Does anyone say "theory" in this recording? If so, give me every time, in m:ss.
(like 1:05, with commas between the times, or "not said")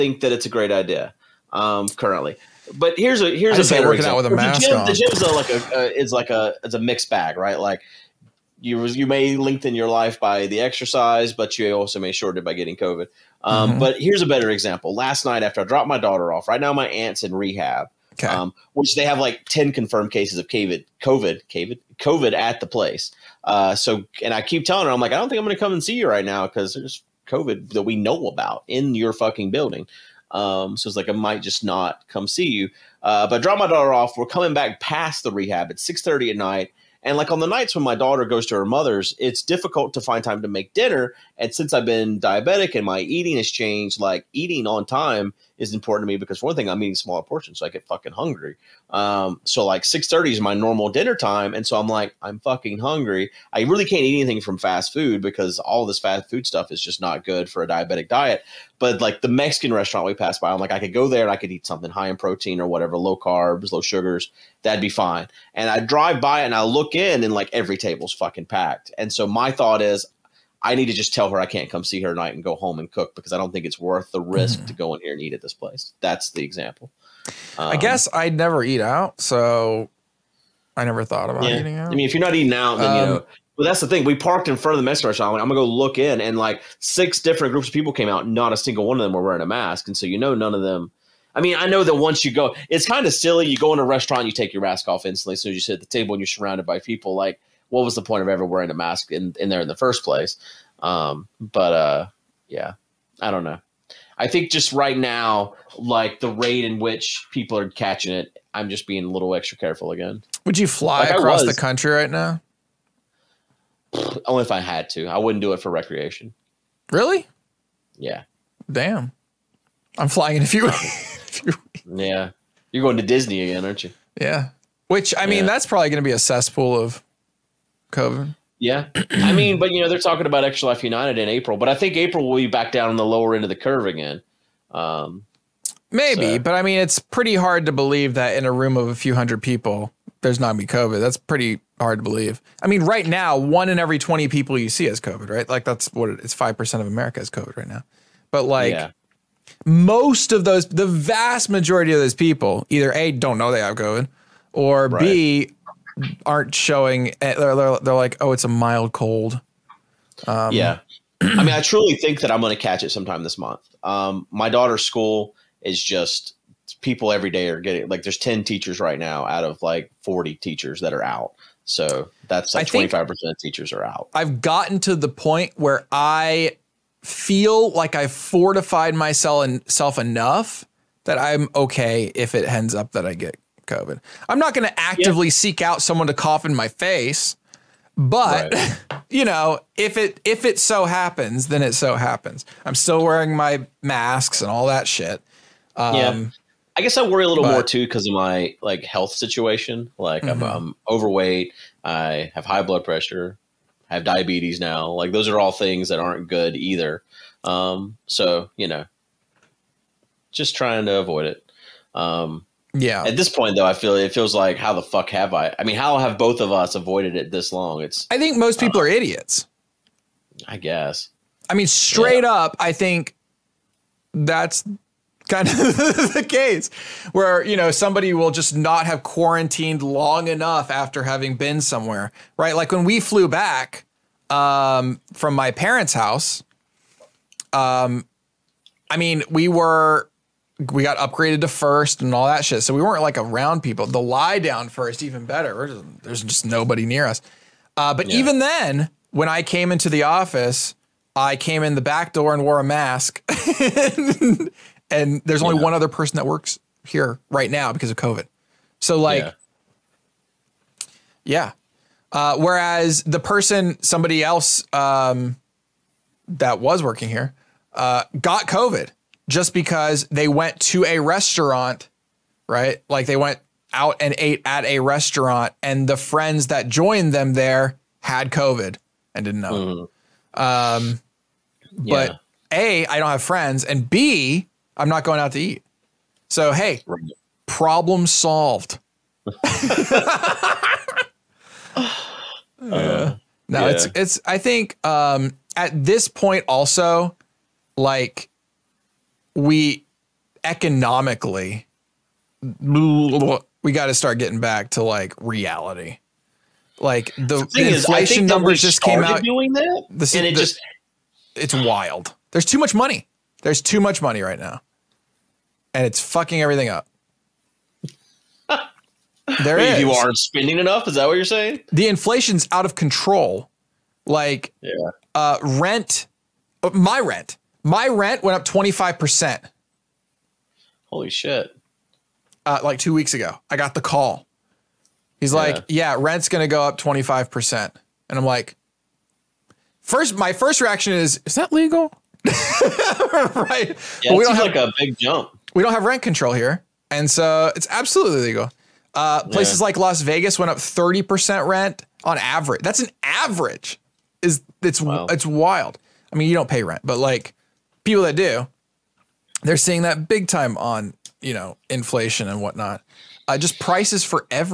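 not said.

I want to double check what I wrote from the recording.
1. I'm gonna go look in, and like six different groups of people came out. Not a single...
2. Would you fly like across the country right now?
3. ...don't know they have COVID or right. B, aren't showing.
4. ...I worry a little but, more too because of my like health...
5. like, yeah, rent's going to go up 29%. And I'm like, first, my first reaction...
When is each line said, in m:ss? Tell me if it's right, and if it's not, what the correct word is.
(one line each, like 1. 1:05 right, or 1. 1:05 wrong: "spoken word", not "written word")
1. 1:25 right
2. 1:50 right
3. 2:33 right
4. 3:16 right
5. 5:35 wrong: "25", not "29".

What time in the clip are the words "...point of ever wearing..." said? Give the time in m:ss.
1:38.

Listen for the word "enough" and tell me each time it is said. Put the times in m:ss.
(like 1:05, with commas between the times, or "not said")
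2:59, 3:50, 5:20.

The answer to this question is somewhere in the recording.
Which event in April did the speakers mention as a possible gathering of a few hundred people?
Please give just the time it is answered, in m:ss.
2:10.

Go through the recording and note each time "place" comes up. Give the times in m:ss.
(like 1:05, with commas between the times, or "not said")
0:22, 1:15, 1:40, 5:49.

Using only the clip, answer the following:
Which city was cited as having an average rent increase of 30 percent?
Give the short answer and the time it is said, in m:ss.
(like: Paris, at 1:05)
Las Vegas, at 5:49.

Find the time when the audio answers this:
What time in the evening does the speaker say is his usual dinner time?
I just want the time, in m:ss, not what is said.
0:49.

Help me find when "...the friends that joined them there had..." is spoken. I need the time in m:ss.
4:35.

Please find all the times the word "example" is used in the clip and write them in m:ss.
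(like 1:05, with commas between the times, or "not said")
0:04, 0:14, 1:16.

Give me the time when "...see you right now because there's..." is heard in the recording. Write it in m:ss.
0:25.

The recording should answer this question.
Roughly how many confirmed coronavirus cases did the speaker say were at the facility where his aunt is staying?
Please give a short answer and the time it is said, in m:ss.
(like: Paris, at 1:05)
10, at 0:19.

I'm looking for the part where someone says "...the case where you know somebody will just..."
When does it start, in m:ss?
3:46.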